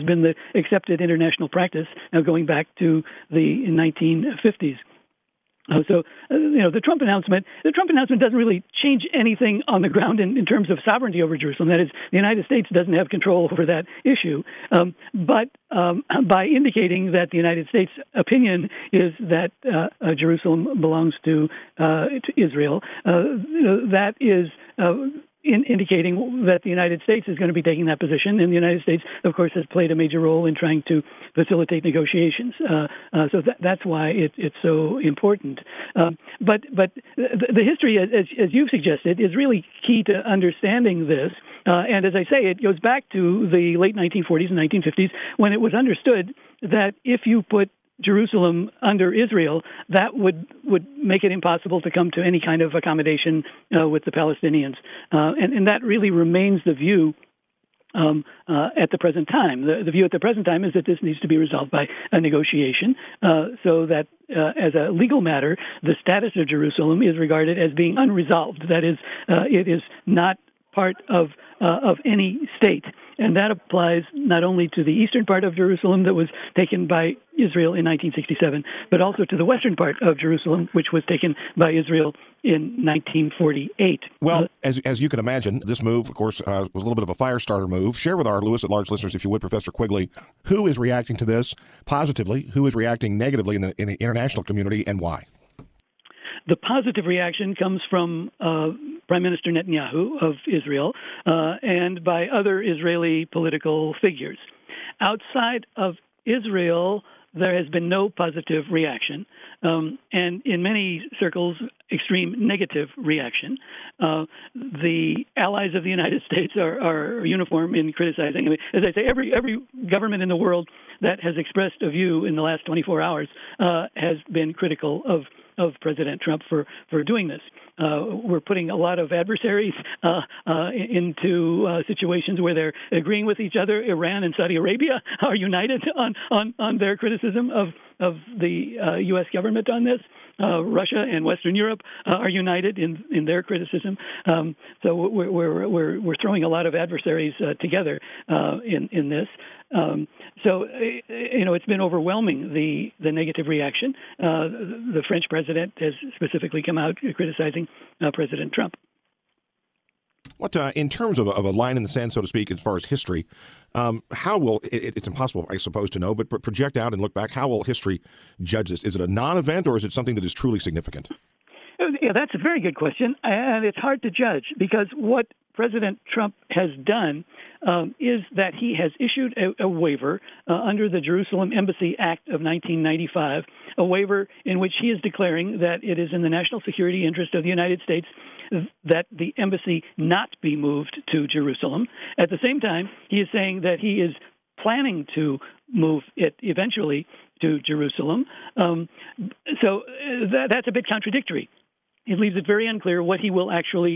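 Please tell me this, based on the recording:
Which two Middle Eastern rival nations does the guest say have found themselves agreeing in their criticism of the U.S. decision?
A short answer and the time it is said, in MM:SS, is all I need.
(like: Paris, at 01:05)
Iran and Saudi Arabia, at 02:13.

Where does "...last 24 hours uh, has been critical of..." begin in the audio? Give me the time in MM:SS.
02:02.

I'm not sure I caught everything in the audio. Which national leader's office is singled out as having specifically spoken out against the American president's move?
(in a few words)
The French president.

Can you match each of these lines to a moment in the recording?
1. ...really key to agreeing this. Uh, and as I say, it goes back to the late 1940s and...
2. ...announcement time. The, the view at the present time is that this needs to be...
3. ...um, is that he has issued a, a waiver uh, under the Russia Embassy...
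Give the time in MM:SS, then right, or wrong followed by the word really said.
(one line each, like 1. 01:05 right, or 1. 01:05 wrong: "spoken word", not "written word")
1. 00:39 wrong: "understanding", not "agreeing"
2. 00:58 wrong: "present", not "announcement"
3. 02:57 wrong: "Jerusalem", not "Russia".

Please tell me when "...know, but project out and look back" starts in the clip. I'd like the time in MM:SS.
02:45.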